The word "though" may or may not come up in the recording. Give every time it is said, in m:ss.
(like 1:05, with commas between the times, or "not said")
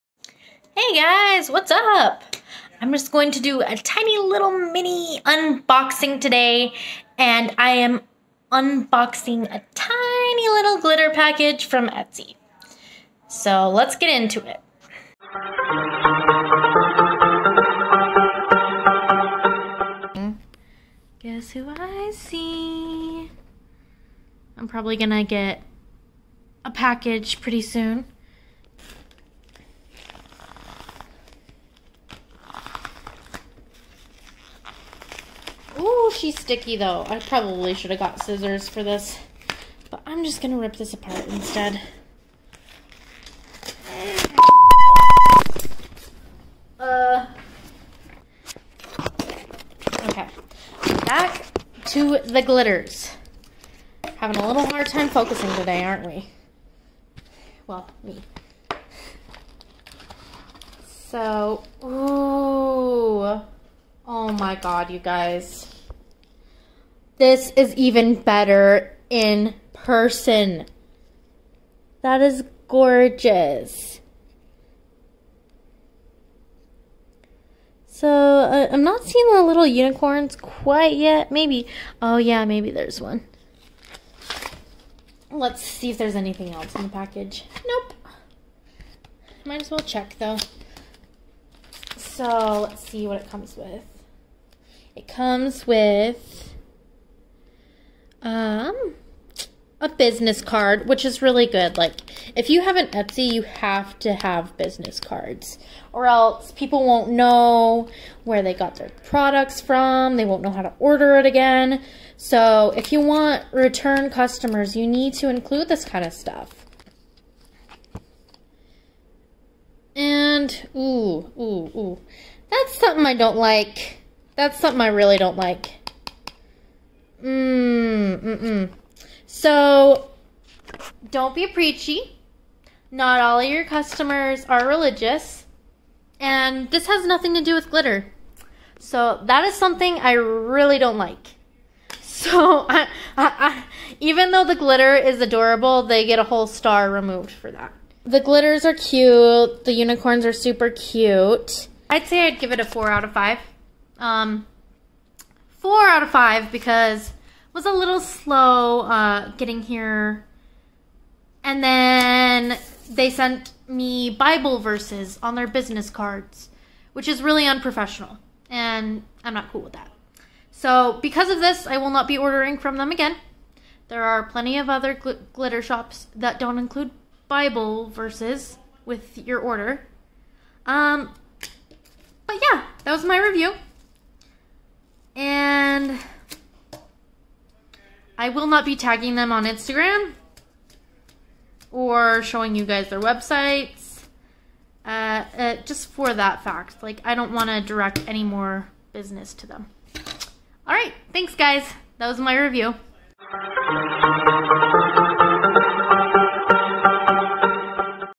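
0:36, 1:30, 2:24.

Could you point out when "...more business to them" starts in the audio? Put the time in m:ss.
3:18.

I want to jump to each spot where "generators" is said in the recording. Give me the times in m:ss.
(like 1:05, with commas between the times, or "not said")
not said.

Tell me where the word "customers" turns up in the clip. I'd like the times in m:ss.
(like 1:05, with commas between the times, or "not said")
1:54, 2:13.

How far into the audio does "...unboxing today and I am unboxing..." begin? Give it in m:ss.
0:05.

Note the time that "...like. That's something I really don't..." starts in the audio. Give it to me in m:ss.
2:03.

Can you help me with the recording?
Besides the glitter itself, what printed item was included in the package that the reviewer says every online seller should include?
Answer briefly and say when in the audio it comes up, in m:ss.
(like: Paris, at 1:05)
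business card, at 1:39.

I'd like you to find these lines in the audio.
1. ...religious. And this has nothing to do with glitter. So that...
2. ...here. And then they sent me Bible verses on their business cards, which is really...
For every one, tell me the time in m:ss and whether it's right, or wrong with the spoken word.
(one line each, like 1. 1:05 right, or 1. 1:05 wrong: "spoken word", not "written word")
1. 2:14 right
2. 2:39 right.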